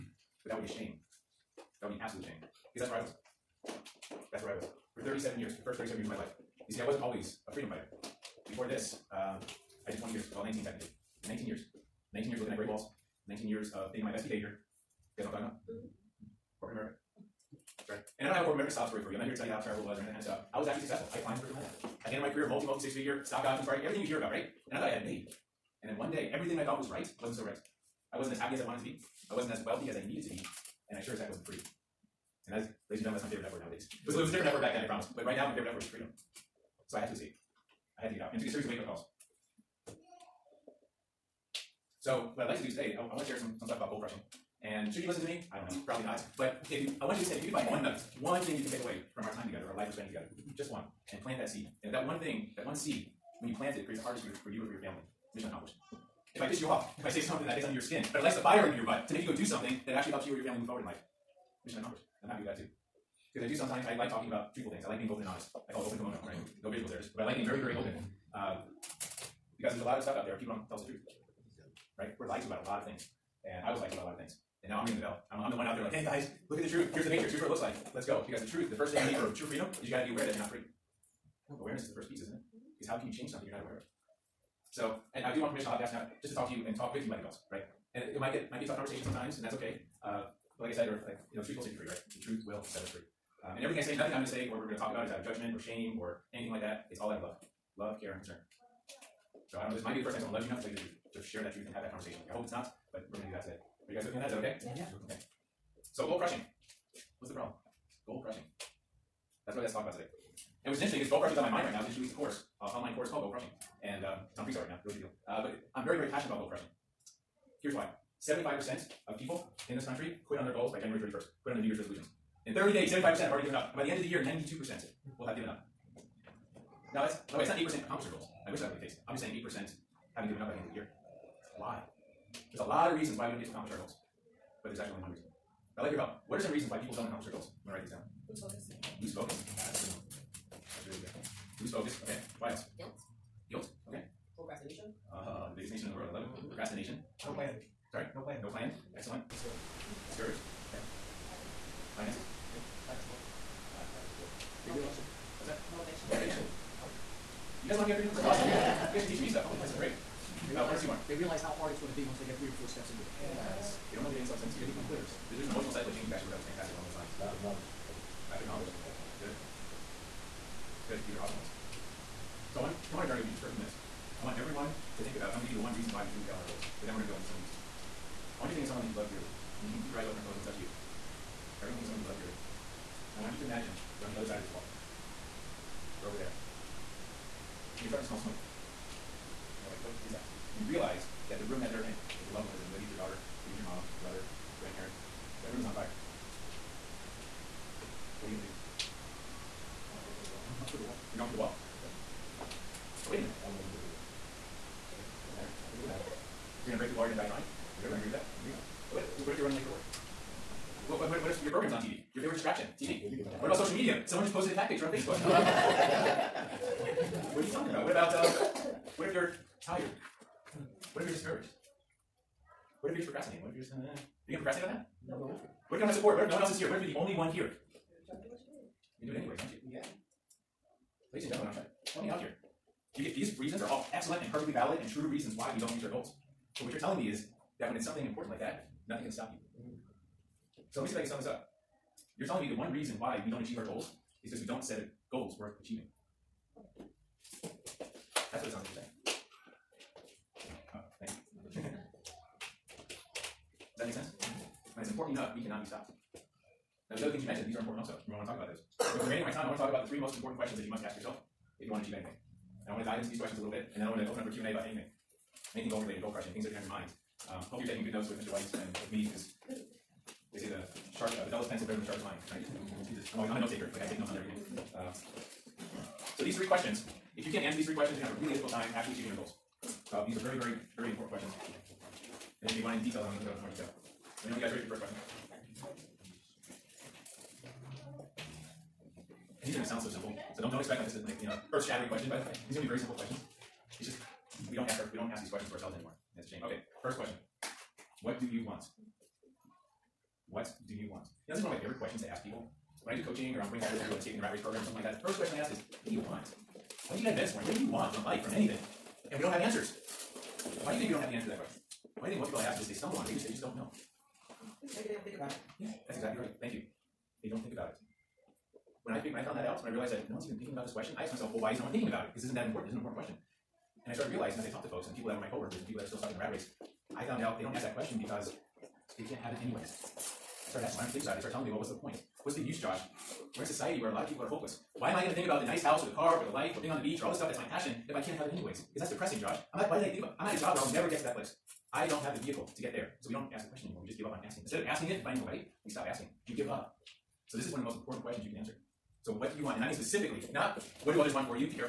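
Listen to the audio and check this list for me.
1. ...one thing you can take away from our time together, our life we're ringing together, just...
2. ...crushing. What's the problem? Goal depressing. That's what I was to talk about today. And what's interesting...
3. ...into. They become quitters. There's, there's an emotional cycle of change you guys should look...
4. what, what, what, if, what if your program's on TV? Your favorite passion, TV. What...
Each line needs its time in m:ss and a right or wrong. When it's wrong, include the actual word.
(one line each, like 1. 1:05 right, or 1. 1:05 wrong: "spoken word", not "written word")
1. 0:48 wrong: "spending", not "ringing"
2. 1:46 wrong: "crushing", not "depressing"
3. 2:44 right
4. 3:30 wrong: "distraction", not "passion".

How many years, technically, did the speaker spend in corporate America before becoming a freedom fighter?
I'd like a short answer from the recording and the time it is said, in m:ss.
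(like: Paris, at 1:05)
19, at 0:10.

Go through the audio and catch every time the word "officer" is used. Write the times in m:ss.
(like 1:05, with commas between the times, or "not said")
not said.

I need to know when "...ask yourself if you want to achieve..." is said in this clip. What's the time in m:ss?
4:20.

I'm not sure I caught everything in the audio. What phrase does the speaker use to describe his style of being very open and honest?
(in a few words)
open kimono.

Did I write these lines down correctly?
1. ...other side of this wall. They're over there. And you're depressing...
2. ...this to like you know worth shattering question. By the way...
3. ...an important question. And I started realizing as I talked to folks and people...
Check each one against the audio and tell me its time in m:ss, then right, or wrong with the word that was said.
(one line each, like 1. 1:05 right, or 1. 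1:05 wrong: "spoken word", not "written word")
1. 3:04 wrong: "starting", not "depressing"
2. 4:50 wrong: "earth", not "worth"
3. 5:22 right.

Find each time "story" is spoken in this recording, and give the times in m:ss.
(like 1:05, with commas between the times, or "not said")
0:18.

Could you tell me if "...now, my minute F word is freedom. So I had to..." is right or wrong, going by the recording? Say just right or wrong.
wrong.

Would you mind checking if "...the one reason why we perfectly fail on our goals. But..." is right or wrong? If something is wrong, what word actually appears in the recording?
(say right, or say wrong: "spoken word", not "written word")
wrong: "truly", not "perfectly".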